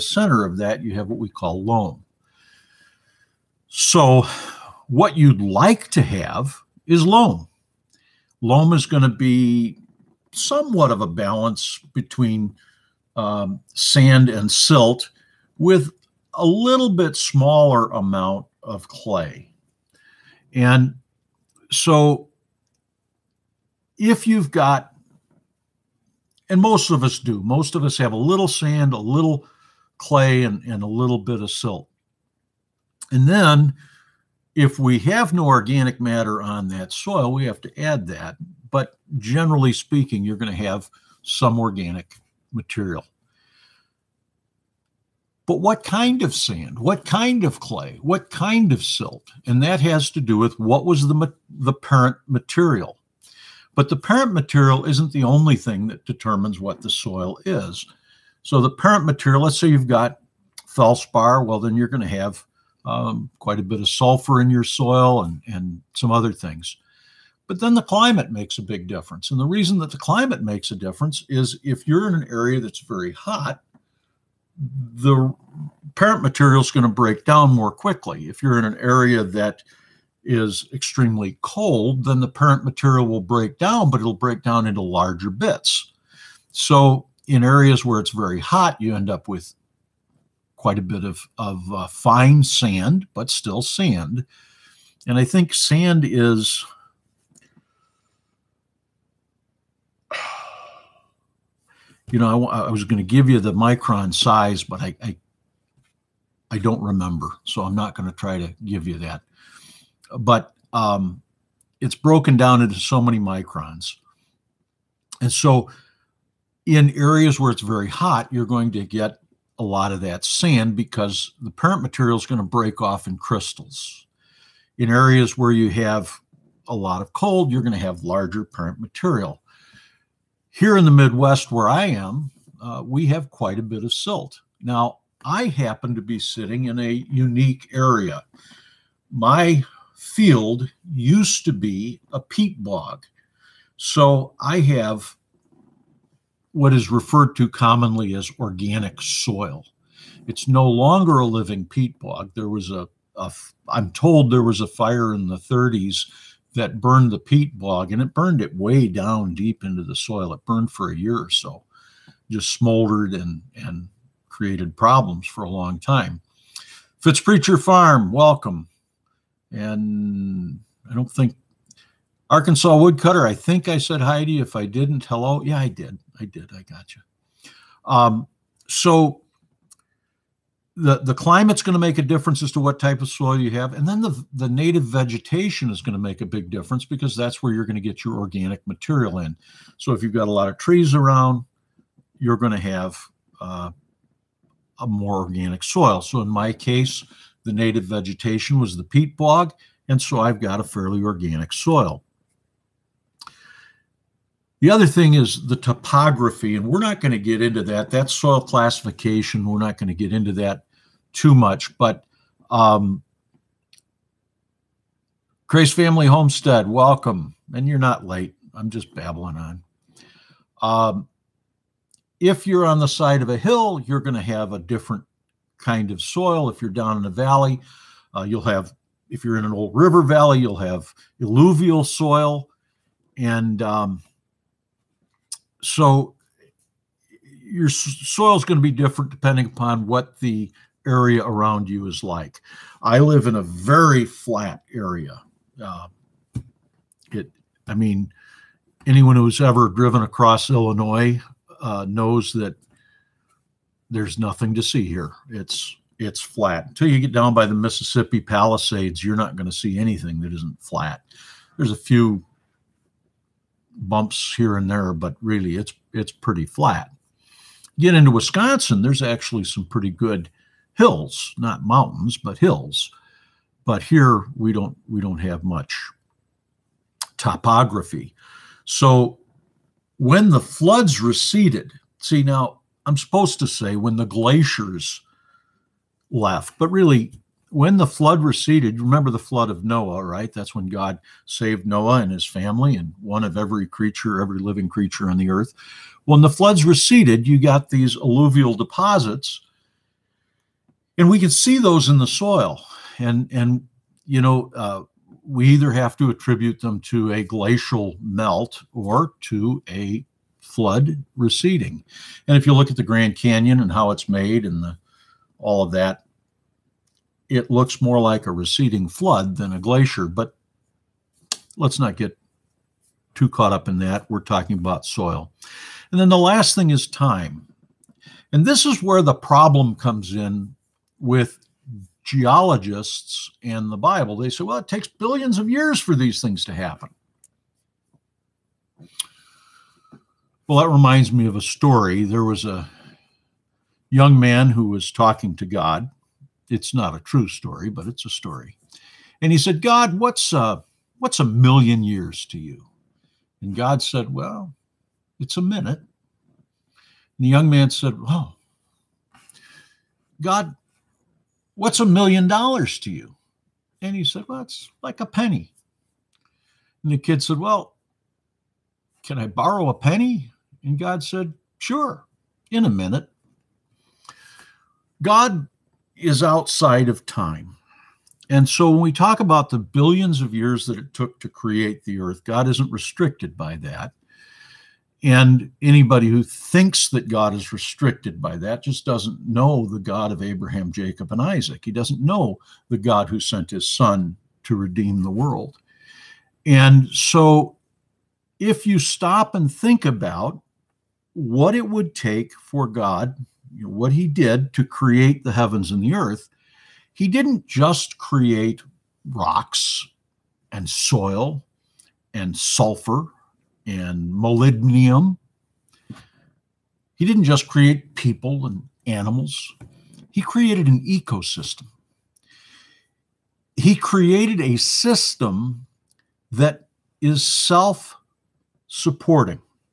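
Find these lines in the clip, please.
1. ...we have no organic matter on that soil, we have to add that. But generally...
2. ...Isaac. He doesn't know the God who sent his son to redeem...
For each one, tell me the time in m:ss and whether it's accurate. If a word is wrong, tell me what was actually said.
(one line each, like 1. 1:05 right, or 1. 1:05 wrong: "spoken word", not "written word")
1. 0:34 right
2. 6:31 right.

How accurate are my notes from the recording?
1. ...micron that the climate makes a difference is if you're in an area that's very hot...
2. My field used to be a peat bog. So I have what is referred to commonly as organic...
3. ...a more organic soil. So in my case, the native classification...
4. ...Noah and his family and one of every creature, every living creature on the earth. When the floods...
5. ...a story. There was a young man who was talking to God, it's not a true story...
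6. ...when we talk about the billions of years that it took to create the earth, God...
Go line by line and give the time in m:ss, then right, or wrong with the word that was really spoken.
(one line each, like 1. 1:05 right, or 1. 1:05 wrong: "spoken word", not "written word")
1. 1:09 wrong: "reason", not "micron"
2. 2:19 right
3. 3:14 wrong: "vegetation", not "classification"
4. 4:51 right
5. 5:41 right
6. 6:18 right.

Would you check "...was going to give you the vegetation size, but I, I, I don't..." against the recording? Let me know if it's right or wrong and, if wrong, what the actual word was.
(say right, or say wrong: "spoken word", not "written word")
wrong: "micron", not "vegetation".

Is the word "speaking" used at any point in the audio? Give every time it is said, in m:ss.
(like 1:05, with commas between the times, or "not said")
0:39.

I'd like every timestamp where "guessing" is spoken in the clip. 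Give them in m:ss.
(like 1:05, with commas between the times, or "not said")
not said.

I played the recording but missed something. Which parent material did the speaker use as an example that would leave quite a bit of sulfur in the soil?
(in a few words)
Feldspar.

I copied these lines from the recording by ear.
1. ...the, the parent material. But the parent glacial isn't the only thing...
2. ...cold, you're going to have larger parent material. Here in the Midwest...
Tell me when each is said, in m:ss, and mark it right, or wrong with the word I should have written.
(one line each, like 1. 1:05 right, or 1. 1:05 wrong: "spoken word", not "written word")
1. 0:51 wrong: "material", not "glacial"
2. 2:07 right.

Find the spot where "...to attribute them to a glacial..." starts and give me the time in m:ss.
5:05.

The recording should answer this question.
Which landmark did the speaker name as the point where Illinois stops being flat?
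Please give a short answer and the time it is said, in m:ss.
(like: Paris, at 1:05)
Mississippi Palisades, at 4:17.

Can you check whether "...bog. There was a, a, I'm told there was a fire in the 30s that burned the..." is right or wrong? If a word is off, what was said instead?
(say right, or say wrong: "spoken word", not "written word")
right.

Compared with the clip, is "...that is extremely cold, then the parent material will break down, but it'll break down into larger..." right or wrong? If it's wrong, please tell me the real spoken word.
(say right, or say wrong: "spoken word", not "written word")
right.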